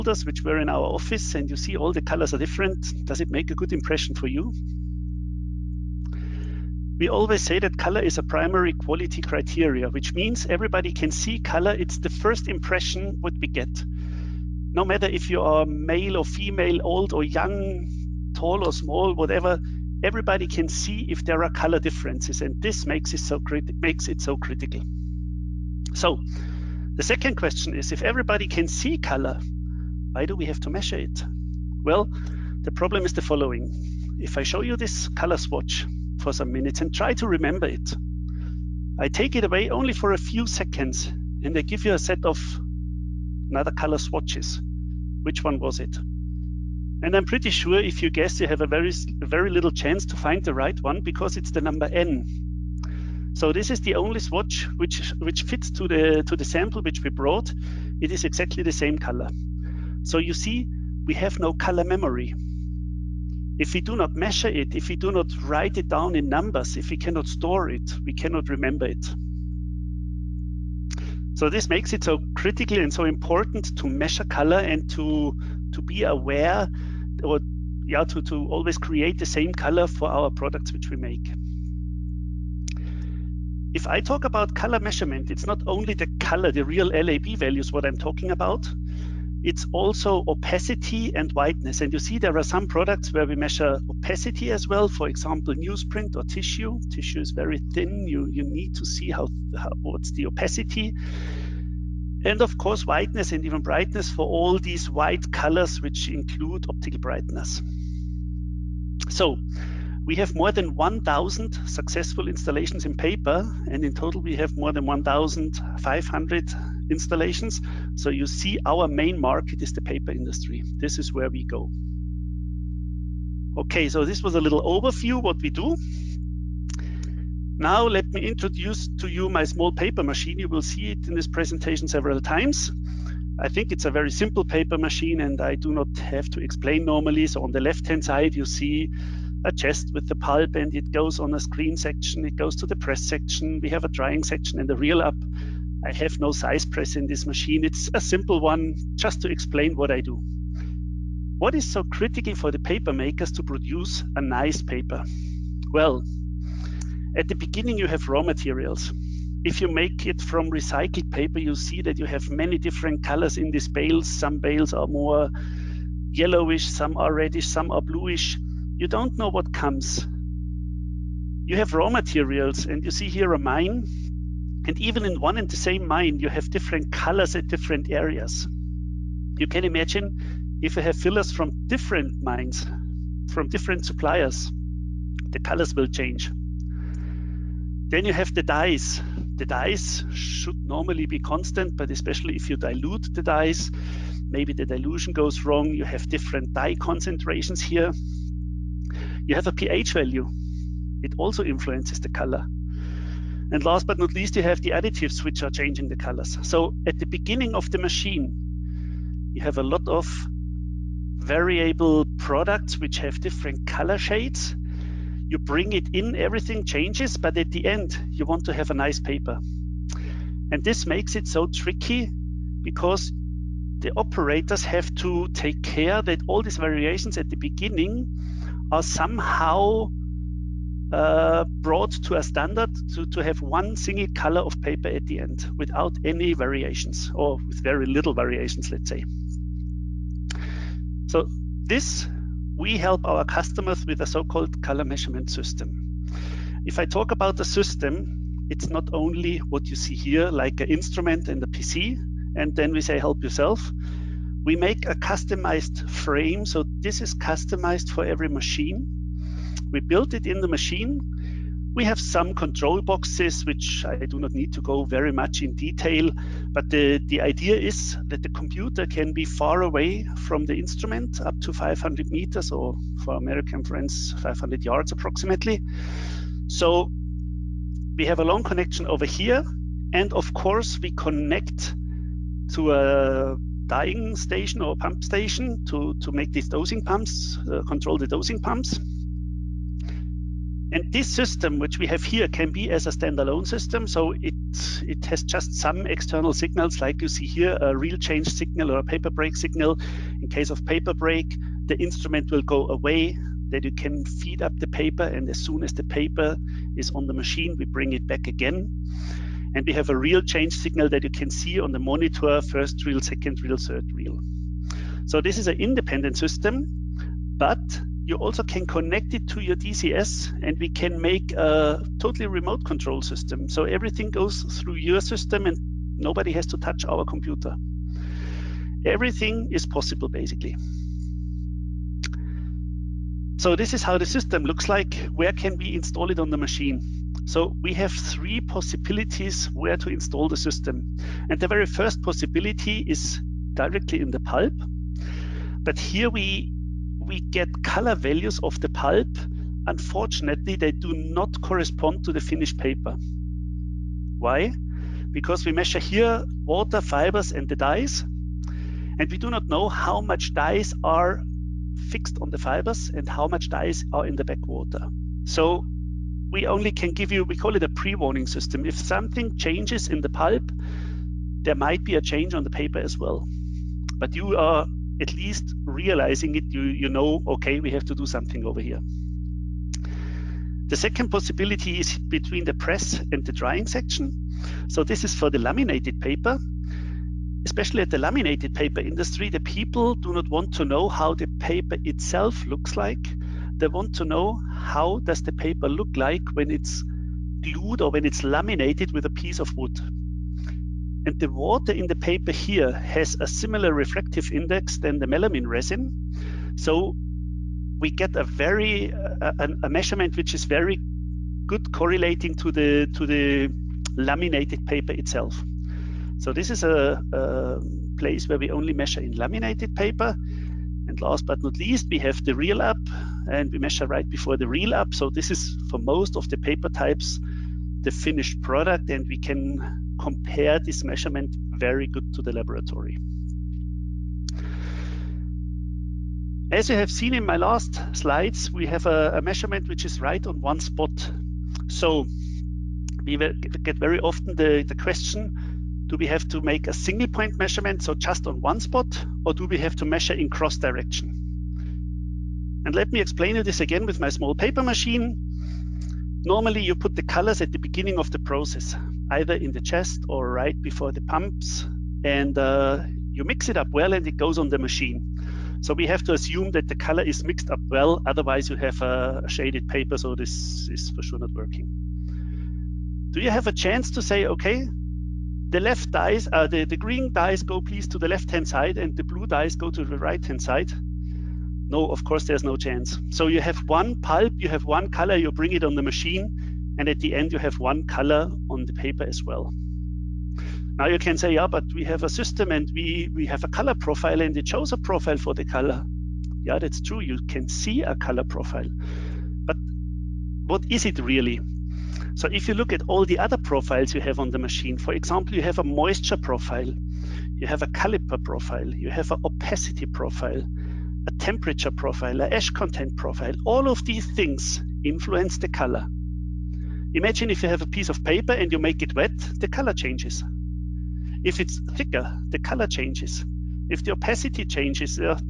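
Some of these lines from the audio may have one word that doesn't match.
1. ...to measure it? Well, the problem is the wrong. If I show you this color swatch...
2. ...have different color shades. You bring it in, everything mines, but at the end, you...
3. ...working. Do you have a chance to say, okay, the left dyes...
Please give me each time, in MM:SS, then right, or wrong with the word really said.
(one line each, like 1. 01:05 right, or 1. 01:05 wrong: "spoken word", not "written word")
1. 00:30 wrong: "following", not "wrong"
2. 03:32 wrong: "changes", not "mines"
3. 07:51 right.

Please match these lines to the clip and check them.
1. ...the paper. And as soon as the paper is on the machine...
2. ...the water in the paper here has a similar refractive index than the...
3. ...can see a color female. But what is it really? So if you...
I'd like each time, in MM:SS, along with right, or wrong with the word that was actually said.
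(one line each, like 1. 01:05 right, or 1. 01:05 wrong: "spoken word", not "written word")
1. 05:04 right
2. 06:41 right
3. 08:17 wrong: "profile", not "female".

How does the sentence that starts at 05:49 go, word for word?
Unfortunately, they do not correspond to the finished paper.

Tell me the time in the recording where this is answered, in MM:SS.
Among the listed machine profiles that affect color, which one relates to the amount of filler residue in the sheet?
08:32.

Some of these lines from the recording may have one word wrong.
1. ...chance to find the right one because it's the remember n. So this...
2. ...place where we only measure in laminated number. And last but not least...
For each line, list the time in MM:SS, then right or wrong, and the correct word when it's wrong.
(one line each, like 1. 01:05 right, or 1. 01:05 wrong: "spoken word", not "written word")
1. 00:49 wrong: "number", not "remember"
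2. 06:57 wrong: "paper", not "number".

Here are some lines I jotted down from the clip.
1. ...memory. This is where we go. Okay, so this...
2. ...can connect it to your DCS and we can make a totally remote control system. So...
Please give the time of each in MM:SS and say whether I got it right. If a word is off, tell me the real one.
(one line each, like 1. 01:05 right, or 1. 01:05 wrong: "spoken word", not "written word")
1. 02:00 wrong: "industry", not "memory"
2. 05:18 right.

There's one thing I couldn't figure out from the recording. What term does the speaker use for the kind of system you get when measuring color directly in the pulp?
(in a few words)
pre-warning system.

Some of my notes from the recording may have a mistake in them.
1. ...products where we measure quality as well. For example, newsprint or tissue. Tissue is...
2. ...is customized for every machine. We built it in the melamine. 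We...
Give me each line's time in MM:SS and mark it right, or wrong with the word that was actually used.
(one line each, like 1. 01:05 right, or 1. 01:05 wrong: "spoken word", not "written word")
1. 01:32 wrong: "opacity", not "quality"
2. 04:17 wrong: "machine", not "melamine".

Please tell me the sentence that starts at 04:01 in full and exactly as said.
So this, we help our customers with a so-called color measurement system.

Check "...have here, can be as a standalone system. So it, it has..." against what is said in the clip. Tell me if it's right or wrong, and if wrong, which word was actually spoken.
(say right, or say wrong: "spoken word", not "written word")
right.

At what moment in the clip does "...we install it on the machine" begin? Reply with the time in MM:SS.
05:35.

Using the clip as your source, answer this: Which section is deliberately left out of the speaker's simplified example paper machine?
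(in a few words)
size press.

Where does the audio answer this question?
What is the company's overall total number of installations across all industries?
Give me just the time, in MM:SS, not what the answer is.
01:54.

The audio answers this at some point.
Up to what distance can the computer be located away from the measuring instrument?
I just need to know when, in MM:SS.
04:31.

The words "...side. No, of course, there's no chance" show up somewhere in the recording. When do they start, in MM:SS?
08:00.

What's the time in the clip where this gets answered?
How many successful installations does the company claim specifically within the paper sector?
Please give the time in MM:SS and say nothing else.
01:50.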